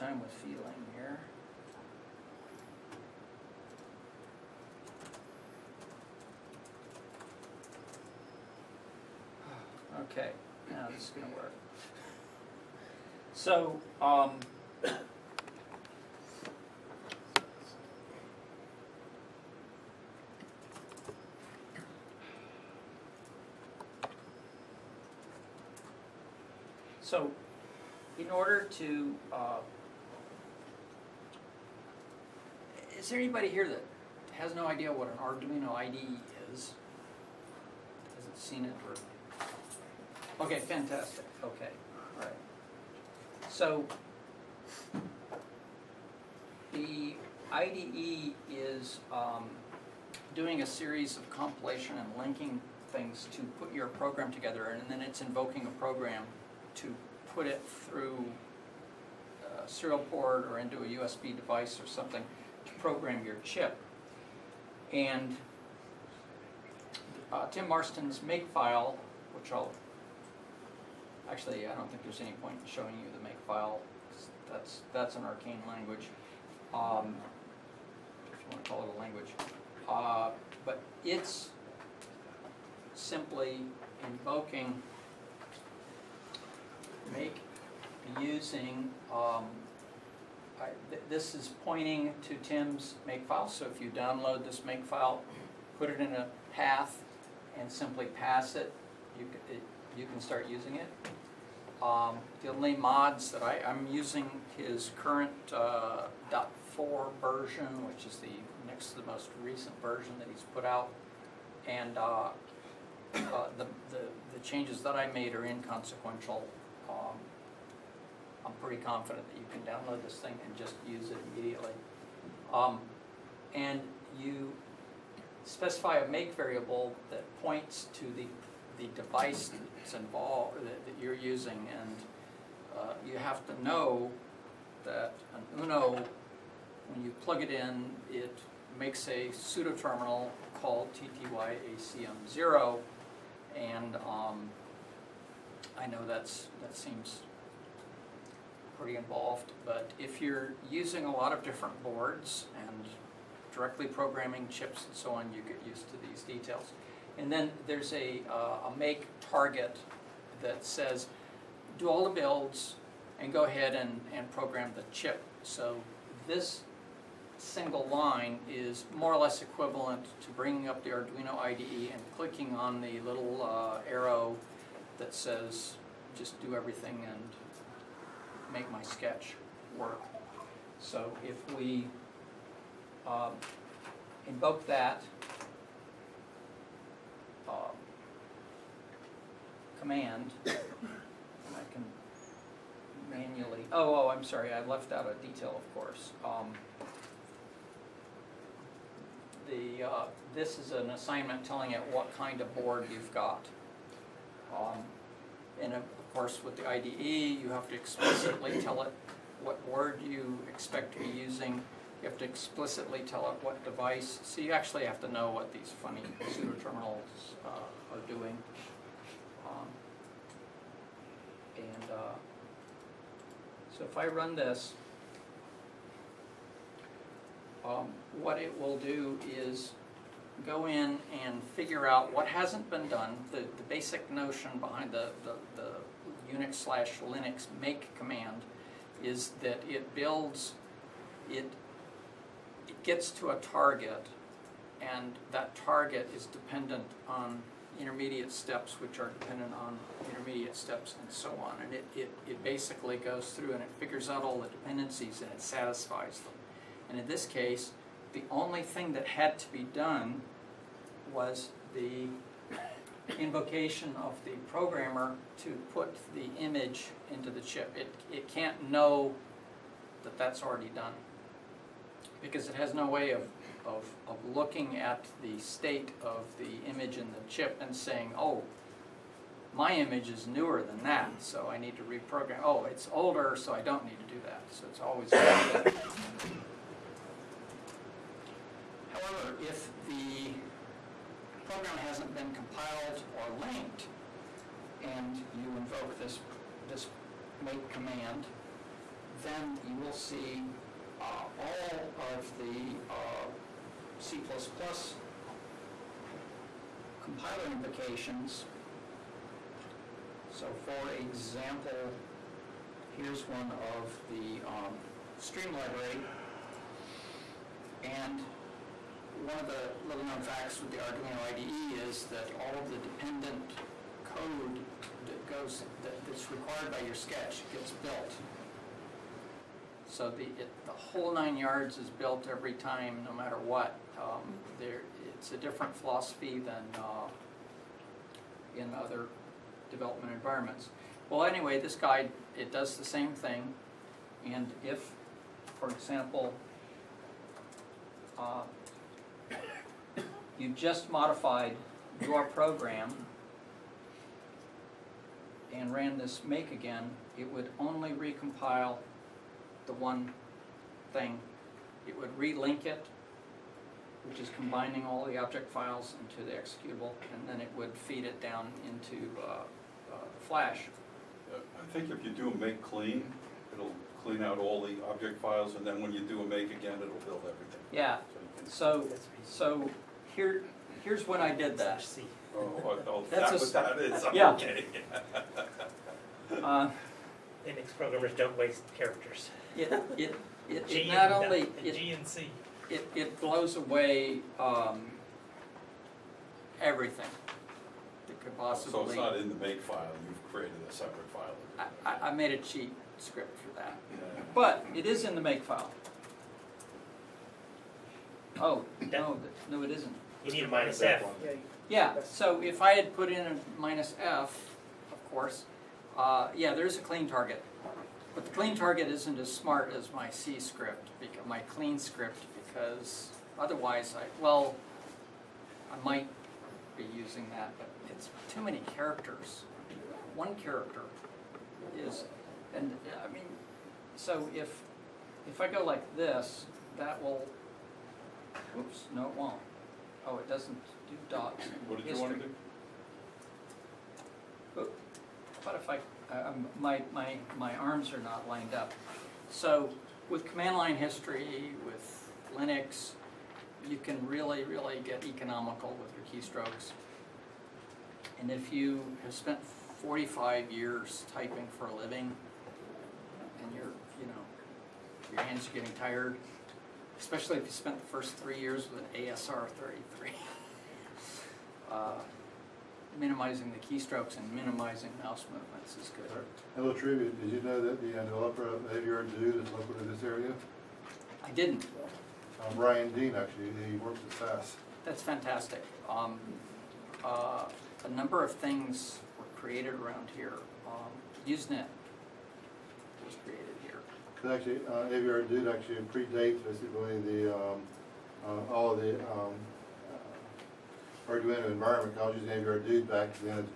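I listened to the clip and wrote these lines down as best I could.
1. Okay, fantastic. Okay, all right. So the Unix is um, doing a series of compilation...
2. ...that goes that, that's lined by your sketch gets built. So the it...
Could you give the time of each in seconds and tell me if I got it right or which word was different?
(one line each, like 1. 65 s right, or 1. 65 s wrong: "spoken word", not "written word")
1. 40 s wrong: "IDE", not "Unix"
2. 325 s wrong: "required", not "lined".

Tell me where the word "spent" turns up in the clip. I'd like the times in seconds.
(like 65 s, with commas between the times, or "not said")
459 s, 467 s.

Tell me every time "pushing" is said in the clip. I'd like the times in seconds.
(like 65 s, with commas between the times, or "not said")
not said.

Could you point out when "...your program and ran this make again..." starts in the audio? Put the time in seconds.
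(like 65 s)
352 s.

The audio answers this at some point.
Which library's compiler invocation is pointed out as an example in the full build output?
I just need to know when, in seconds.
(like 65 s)
315 s.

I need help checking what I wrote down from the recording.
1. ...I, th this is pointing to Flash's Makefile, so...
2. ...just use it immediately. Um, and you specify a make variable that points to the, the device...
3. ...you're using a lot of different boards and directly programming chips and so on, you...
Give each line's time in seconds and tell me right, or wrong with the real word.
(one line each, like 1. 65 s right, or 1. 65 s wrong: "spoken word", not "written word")
1. 90 s wrong: "Tim", not "Flash"
2. 120 s right
3. 150 s right.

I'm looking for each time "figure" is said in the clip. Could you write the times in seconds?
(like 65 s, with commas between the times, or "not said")
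231 s, 253 s.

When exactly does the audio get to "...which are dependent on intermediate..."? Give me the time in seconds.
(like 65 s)
248 s.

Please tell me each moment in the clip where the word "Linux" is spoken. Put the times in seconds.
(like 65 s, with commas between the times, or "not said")
236 s, 387 s, 452 s.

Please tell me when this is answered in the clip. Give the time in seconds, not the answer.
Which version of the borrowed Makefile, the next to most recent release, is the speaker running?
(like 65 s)
106 s.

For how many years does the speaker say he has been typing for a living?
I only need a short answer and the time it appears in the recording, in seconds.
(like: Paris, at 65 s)
45, at 459 s.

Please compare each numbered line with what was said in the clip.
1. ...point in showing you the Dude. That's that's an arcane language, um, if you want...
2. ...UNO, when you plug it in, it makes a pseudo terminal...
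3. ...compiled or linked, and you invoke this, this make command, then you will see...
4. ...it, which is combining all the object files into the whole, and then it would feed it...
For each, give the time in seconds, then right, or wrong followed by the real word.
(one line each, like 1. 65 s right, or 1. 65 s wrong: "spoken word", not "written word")
1. 72 s wrong: "Makefile", not "Dude"
2. 135 s right
3. 292 s right
4. 362 s wrong: "executable", not "whole".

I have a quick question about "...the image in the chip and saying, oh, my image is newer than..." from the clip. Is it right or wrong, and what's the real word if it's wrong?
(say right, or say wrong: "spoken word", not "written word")
right.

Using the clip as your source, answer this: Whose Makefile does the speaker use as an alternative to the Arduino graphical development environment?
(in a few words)
Tim Marston.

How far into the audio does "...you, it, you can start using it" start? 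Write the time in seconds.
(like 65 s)
99 s.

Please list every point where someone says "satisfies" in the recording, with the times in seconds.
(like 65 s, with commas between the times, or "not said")
255 s.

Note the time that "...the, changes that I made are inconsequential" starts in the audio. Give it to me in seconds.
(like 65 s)
114 s.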